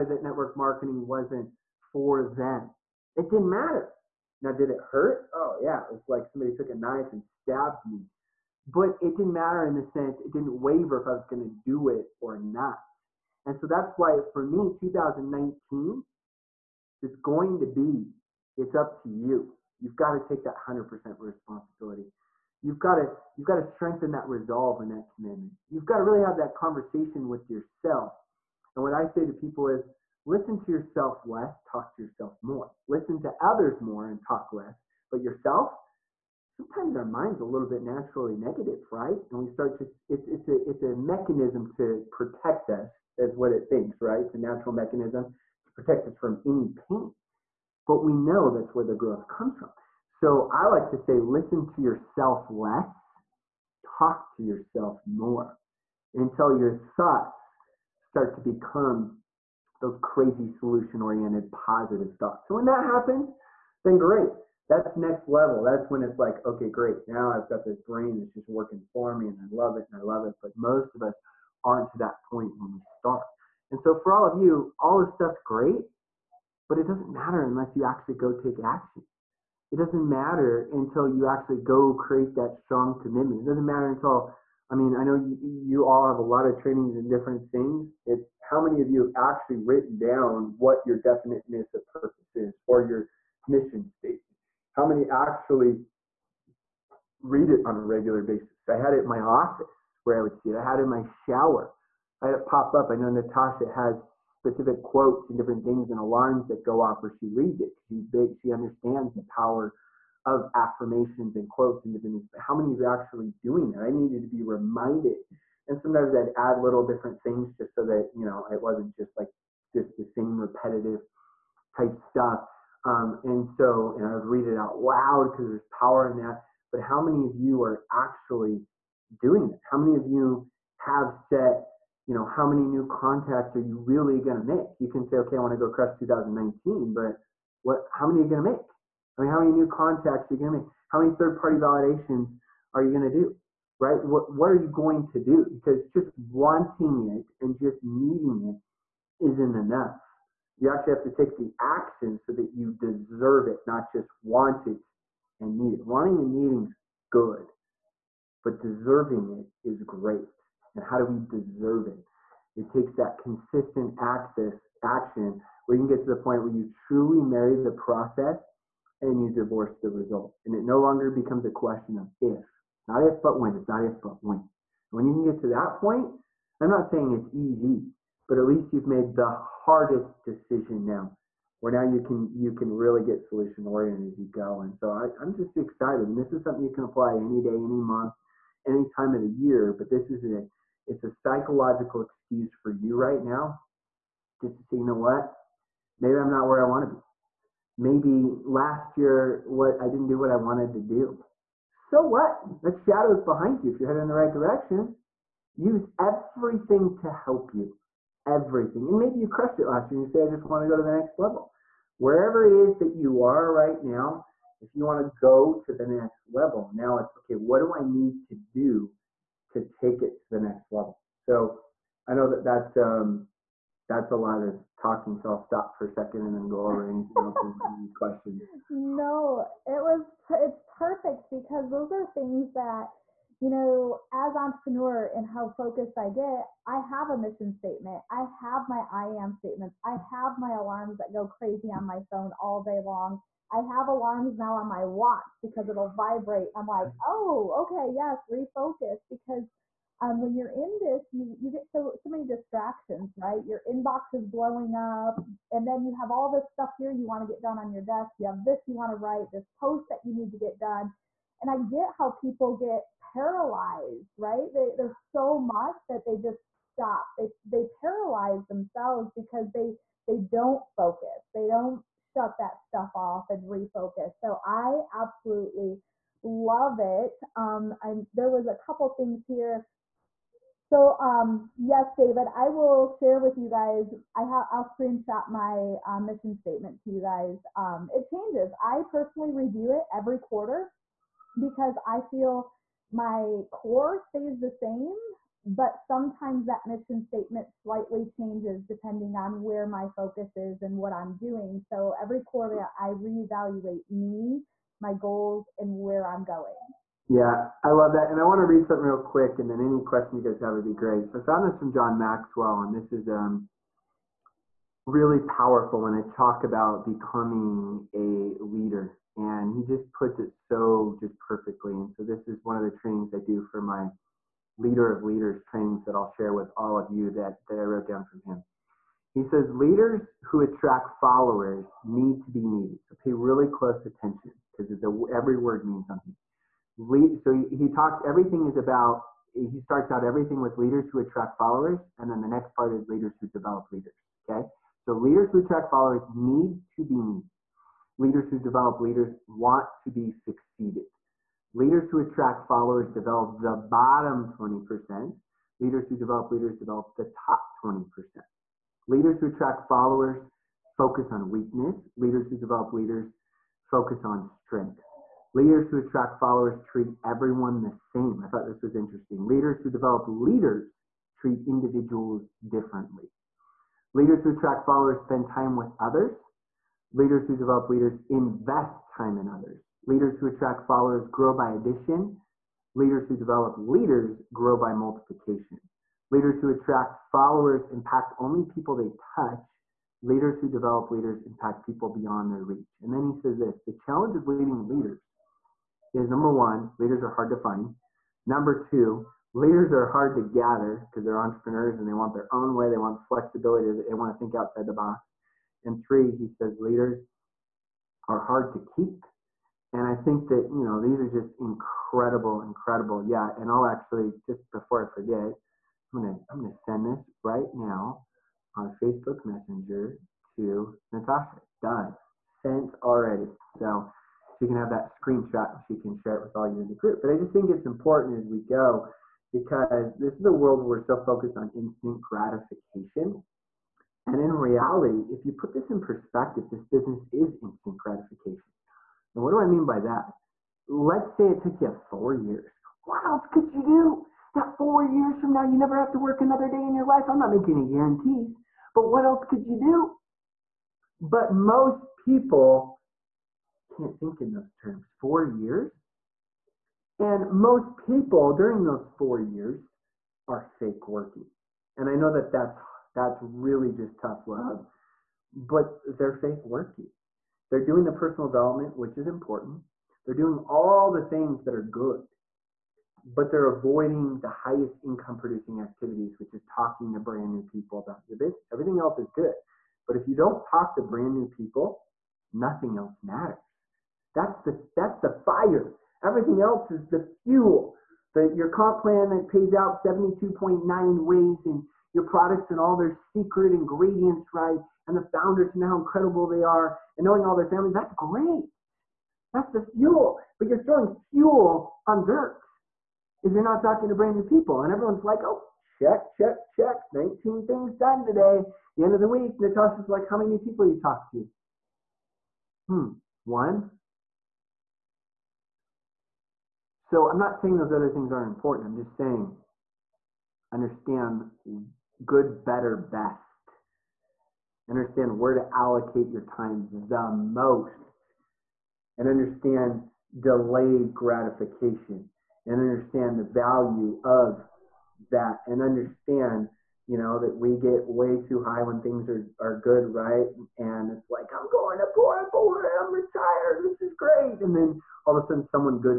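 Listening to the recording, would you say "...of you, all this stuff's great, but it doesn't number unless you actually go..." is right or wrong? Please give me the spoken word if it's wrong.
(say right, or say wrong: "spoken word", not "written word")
wrong: "matter", not "number".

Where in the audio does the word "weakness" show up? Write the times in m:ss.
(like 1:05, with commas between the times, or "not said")
6:01.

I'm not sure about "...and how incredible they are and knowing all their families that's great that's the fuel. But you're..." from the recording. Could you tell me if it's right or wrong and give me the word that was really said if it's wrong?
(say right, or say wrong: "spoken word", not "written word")
right.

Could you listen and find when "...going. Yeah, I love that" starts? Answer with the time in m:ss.
5:06.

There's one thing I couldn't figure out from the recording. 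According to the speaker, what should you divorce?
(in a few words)
The result.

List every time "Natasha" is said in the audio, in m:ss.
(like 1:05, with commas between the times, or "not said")
1:43, 7:00, 8:29.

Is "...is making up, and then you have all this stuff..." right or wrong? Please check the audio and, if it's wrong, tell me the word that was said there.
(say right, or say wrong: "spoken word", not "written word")
wrong: "blowing", not "making".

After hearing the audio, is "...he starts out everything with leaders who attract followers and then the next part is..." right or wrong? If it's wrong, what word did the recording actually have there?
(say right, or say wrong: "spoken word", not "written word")
right.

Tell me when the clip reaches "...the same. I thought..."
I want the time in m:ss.
6:07.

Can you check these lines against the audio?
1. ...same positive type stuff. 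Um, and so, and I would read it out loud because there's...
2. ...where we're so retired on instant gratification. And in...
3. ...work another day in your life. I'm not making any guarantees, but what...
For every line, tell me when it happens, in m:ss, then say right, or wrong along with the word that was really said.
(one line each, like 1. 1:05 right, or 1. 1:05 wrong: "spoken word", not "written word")
1. 2:00 wrong: "repetitive", not "positive"
2. 7:10 wrong: "focused", not "retired"
3. 7:25 right.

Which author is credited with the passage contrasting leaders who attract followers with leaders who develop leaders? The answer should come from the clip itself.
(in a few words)
John Maxwell.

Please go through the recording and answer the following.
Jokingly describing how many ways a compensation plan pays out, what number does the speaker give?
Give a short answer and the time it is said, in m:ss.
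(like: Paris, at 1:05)
72.9, at 8:09.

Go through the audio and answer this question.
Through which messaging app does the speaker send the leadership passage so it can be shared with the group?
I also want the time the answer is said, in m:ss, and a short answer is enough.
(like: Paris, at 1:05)
Facebook Messenger, at 6:58.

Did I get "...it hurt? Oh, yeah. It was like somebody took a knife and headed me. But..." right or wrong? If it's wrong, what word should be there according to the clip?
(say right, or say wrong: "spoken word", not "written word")
wrong: "stabbed", not "headed".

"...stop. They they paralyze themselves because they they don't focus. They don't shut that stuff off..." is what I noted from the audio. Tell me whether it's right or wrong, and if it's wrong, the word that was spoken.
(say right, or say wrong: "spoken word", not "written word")
right.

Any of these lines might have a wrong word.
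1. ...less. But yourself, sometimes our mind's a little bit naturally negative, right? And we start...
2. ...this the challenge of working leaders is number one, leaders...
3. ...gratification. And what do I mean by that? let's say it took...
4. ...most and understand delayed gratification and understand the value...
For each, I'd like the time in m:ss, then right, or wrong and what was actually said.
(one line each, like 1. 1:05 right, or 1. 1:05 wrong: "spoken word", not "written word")
1. 0:34 right
2. 6:33 wrong: "leading", not "working"
3. 7:17 right
4. 8:47 right.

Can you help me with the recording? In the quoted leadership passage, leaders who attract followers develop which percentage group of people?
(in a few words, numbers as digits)
The bottom 20%.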